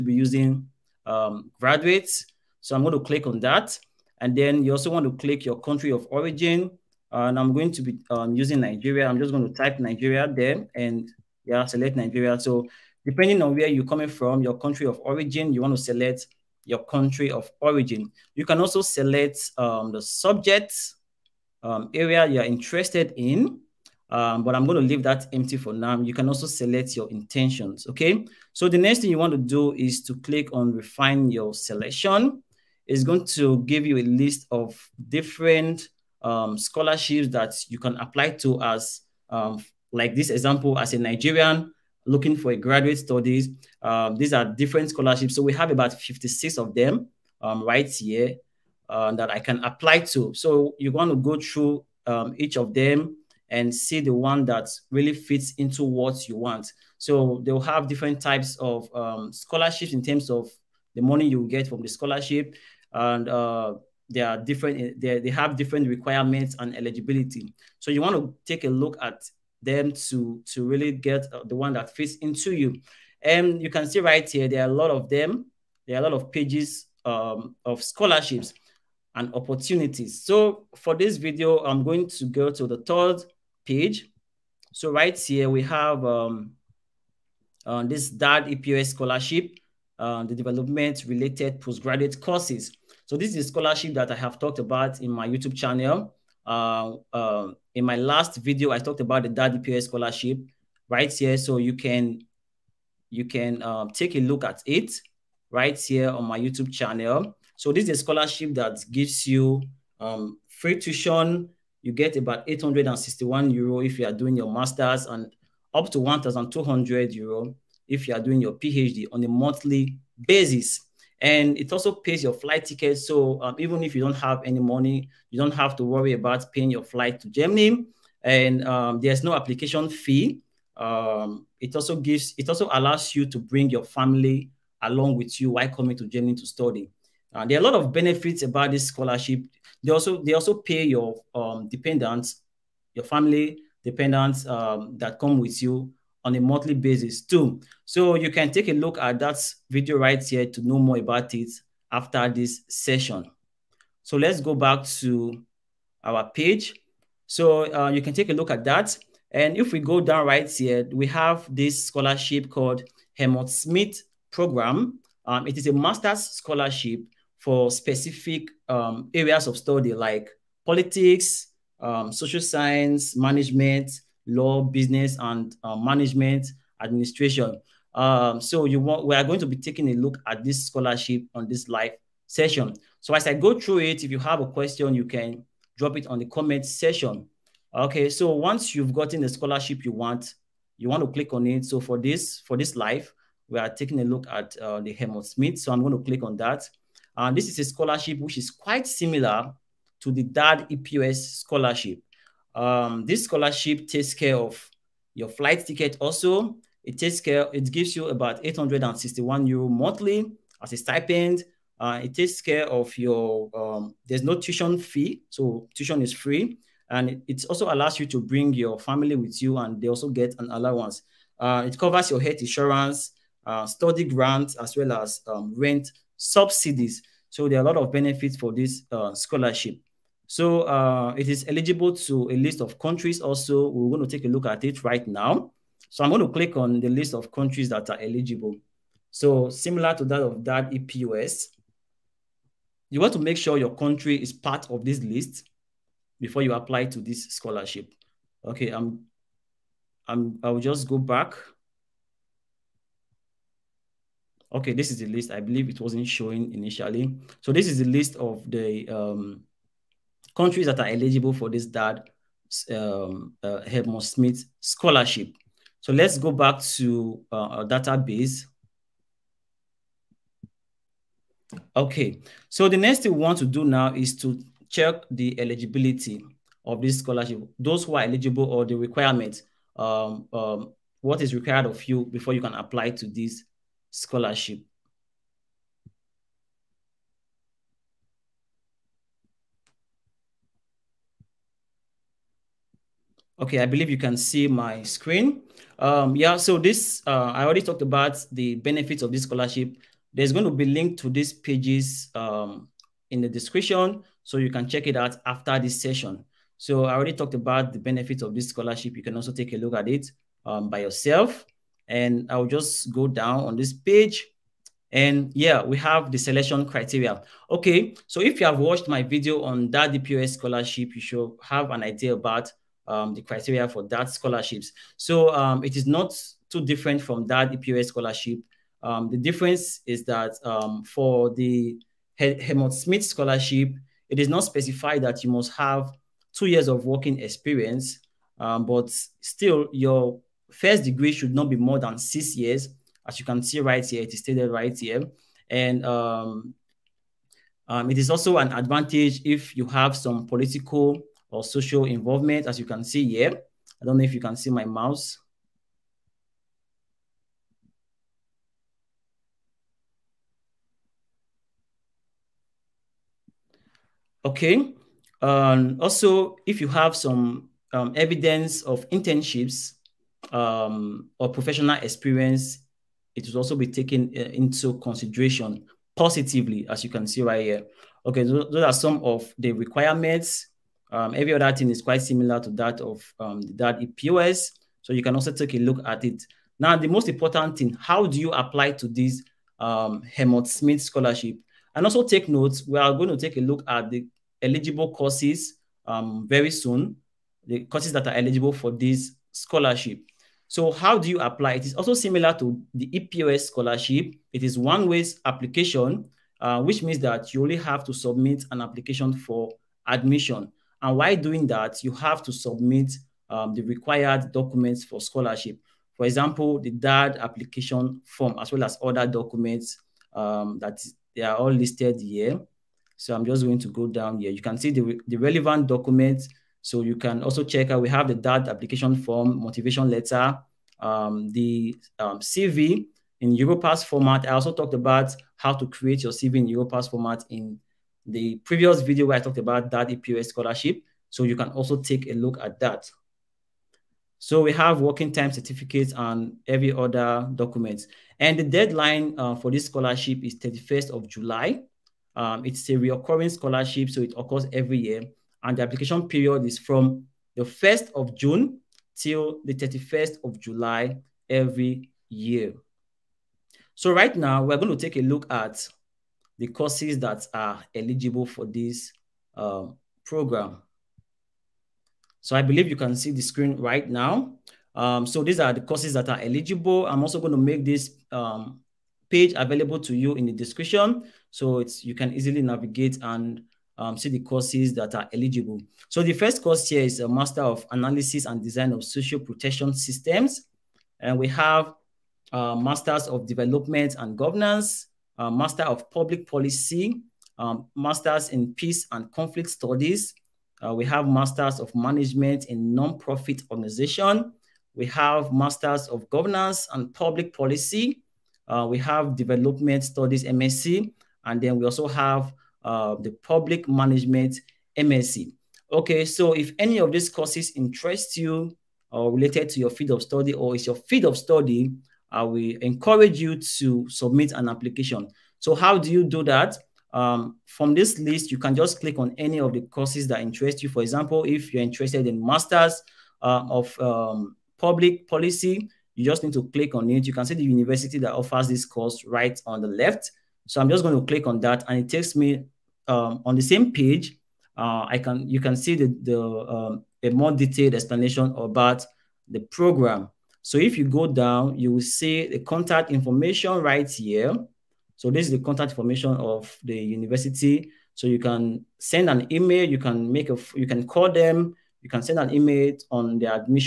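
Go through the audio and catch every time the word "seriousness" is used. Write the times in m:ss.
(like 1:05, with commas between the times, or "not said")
not said.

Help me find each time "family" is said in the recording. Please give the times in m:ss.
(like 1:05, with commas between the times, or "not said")
2:13, 2:23, 3:38.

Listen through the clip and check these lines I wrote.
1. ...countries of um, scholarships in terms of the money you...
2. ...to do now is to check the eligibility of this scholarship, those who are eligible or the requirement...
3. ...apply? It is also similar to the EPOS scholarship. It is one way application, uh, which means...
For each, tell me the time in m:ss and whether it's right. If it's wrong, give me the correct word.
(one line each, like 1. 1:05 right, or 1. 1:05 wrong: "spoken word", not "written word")
1. 0:58 wrong: "types", not "countries"
2. 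4:33 right
3. 6:41 right.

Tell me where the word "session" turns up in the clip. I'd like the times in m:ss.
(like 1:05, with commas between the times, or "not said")
2:32, 3:02, 5:05.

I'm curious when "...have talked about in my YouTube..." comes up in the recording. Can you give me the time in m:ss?
1:34.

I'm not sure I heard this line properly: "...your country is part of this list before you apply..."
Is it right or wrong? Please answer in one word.
right.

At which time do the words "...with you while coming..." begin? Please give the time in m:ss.
2:15.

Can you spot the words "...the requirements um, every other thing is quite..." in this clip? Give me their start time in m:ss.
6:19.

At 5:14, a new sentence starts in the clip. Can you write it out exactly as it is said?
And yeah, we have the selection criteria.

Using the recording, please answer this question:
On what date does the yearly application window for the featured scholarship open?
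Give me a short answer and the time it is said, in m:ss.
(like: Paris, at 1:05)
1st of June, at 7:37.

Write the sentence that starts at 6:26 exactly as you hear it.
Now, the most important thing, how do you apply to this um, Schmidt scholarship?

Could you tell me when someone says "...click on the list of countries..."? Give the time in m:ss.
3:56.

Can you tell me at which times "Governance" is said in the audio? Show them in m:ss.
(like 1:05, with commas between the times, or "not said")
8:14, 8:26.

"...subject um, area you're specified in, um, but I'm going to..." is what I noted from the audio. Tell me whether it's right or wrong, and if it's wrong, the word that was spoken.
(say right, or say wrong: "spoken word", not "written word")
wrong: "interested", not "specified".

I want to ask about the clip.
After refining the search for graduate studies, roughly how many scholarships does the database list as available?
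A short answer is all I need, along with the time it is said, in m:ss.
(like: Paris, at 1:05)
56, at 0:45.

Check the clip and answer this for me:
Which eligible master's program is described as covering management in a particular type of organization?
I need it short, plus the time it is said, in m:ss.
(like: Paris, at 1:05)
Management in Nonprofit Organization, at 8:21.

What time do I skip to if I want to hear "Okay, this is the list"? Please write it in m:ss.
4:14.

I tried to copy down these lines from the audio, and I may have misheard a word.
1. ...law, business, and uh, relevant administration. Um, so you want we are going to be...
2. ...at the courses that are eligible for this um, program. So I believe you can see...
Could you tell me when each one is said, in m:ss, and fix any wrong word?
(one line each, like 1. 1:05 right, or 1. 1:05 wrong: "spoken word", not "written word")
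1. 2:54 wrong: "management", not "relevant"
2. 7:45 right.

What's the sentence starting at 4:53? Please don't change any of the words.
Okay, I believe you can see my screen.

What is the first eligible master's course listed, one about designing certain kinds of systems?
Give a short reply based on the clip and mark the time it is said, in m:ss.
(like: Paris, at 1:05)
Analysis and Design of Social Protection Systems, at 8:07.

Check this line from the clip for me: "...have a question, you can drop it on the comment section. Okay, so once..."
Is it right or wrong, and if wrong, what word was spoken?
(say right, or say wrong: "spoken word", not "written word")
right.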